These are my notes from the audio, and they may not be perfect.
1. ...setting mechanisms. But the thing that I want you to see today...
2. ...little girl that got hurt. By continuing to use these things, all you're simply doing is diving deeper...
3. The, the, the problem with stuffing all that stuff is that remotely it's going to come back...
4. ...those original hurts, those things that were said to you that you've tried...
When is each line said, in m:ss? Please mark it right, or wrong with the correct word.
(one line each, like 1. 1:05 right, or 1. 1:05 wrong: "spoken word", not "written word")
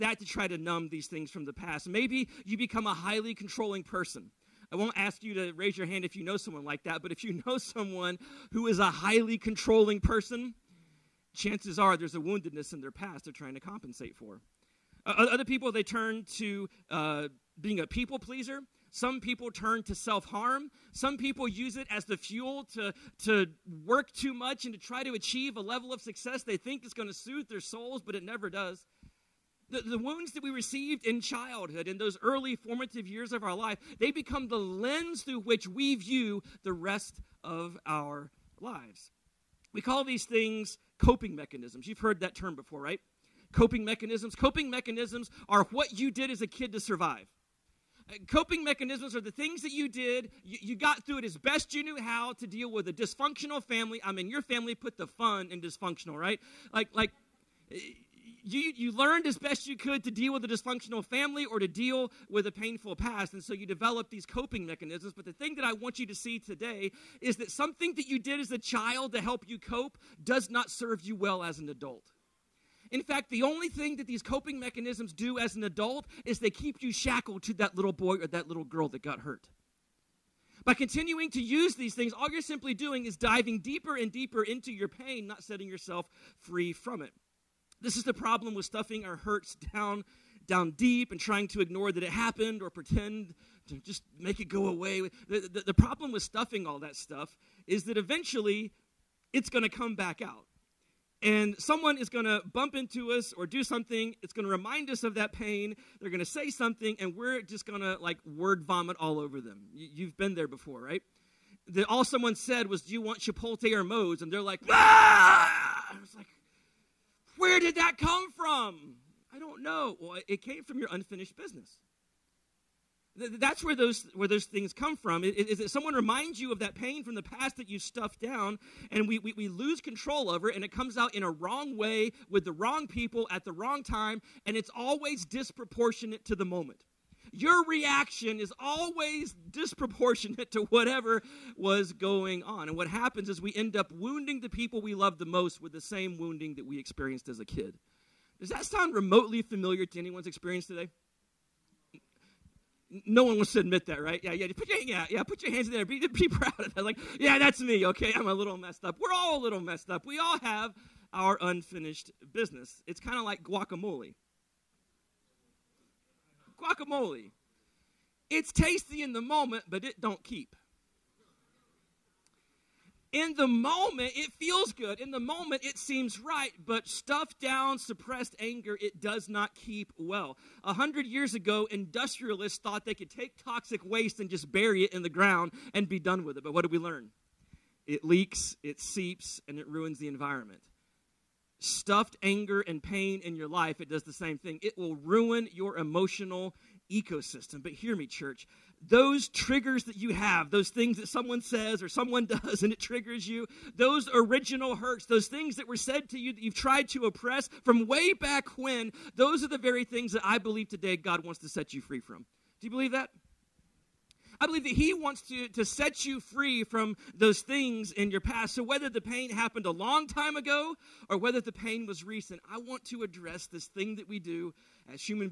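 1. 1:04 wrong: "coping", not "setting"
2. 1:18 right
3. 1:35 wrong: "eventually", not "remotely"
4. 3:23 right.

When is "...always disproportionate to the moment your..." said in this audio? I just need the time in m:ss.
2:14.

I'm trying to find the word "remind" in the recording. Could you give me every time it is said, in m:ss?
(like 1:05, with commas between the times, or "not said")
1:44, 2:05.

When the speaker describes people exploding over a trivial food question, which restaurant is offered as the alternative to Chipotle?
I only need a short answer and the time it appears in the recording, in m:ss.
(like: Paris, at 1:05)
Moe's, at 1:53.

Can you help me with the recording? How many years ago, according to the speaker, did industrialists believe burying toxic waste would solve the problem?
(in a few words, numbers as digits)
100.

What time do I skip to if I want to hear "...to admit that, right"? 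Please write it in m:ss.
2:33.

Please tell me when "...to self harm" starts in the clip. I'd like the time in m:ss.
0:19.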